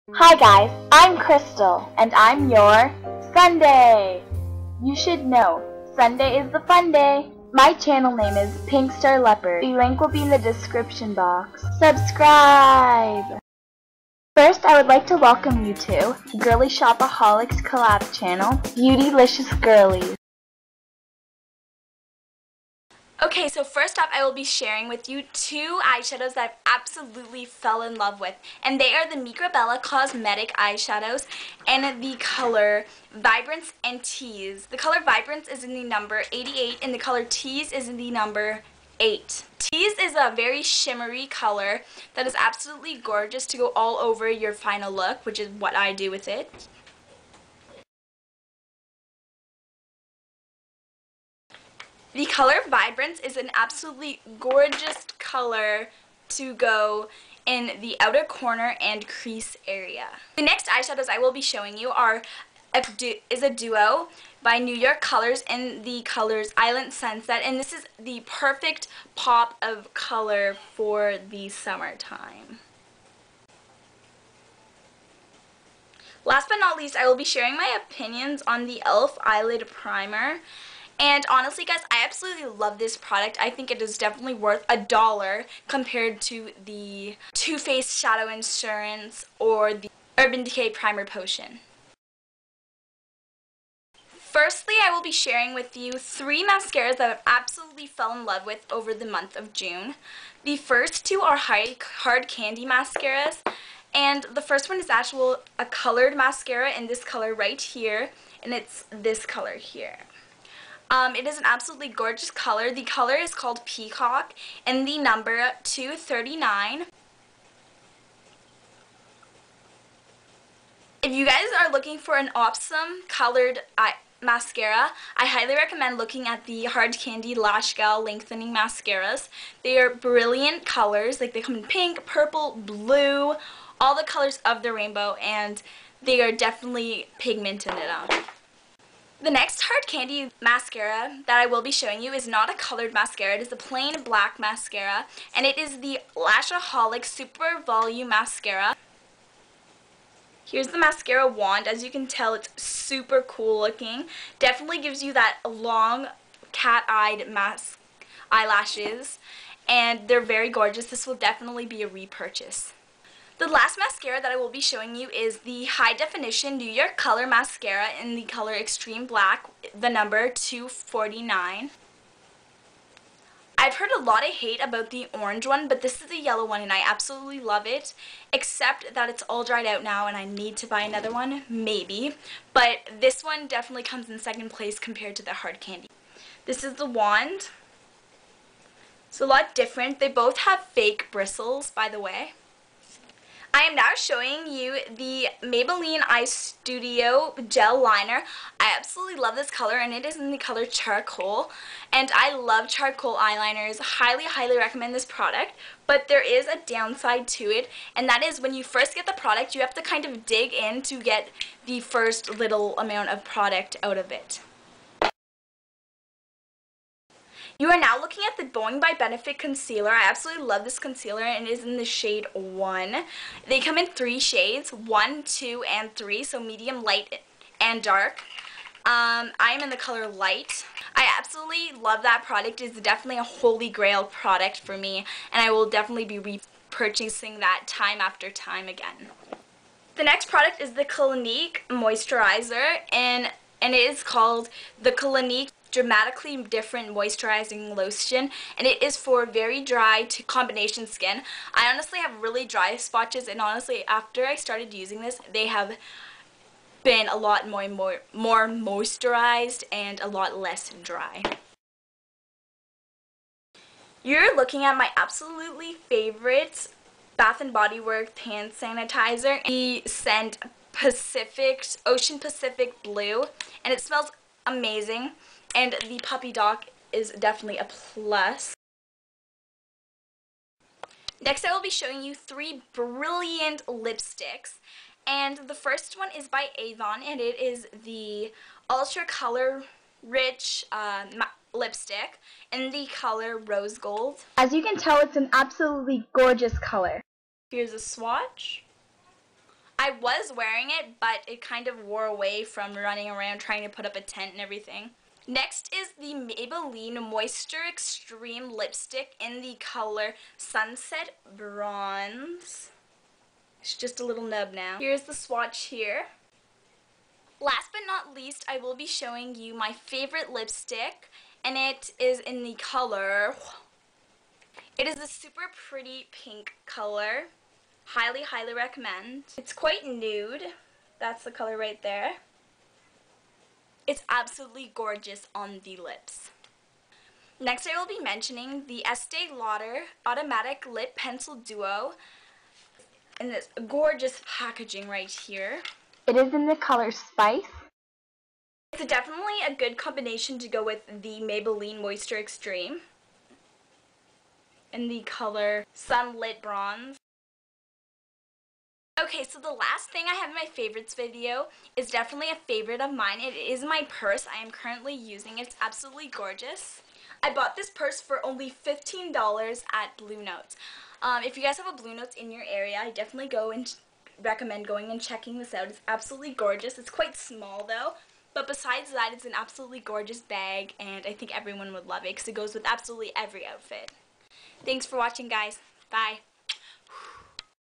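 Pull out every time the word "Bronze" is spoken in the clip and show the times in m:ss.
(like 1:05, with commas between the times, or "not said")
5:11, 5:56.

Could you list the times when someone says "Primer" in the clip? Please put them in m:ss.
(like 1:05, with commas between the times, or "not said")
1:19, 1:30.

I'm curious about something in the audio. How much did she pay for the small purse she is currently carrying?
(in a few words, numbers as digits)
$15.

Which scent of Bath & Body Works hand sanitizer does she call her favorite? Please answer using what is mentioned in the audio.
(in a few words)
Ocean Pacific Blue.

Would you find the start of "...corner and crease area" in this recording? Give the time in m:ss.
0:58.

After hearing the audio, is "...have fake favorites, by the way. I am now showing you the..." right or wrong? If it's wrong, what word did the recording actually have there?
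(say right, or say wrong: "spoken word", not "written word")
wrong: "bristles", not "favorites".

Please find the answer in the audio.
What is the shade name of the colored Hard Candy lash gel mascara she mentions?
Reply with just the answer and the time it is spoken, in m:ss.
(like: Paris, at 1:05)
Peacock, at 1:53.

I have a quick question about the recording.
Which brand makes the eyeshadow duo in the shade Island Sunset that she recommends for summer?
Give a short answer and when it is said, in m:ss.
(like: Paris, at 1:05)
New York Colors, at 1:04.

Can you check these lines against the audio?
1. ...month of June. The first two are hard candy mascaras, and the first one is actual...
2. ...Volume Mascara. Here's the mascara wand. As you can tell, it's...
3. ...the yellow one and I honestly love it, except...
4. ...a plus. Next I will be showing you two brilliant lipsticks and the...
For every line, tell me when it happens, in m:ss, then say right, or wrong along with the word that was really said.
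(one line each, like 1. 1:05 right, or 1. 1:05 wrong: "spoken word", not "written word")
1. 1:39 right
2. 2:27 right
3. 2:56 wrong: "absolutely", not "honestly"
4. 4:37 wrong: "three", not "two".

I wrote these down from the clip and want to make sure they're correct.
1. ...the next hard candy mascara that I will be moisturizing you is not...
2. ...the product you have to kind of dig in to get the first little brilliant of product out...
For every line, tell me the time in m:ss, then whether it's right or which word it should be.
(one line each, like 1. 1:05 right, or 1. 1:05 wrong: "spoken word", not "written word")
1. 2:19 wrong: "showing", not "moisturizing"
2. 3:29 wrong: "amount", not "brilliant".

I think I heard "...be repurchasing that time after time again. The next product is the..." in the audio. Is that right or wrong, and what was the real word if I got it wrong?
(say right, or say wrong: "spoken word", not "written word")
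right.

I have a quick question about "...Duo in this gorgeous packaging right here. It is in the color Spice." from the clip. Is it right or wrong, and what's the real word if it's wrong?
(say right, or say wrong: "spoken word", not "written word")
right.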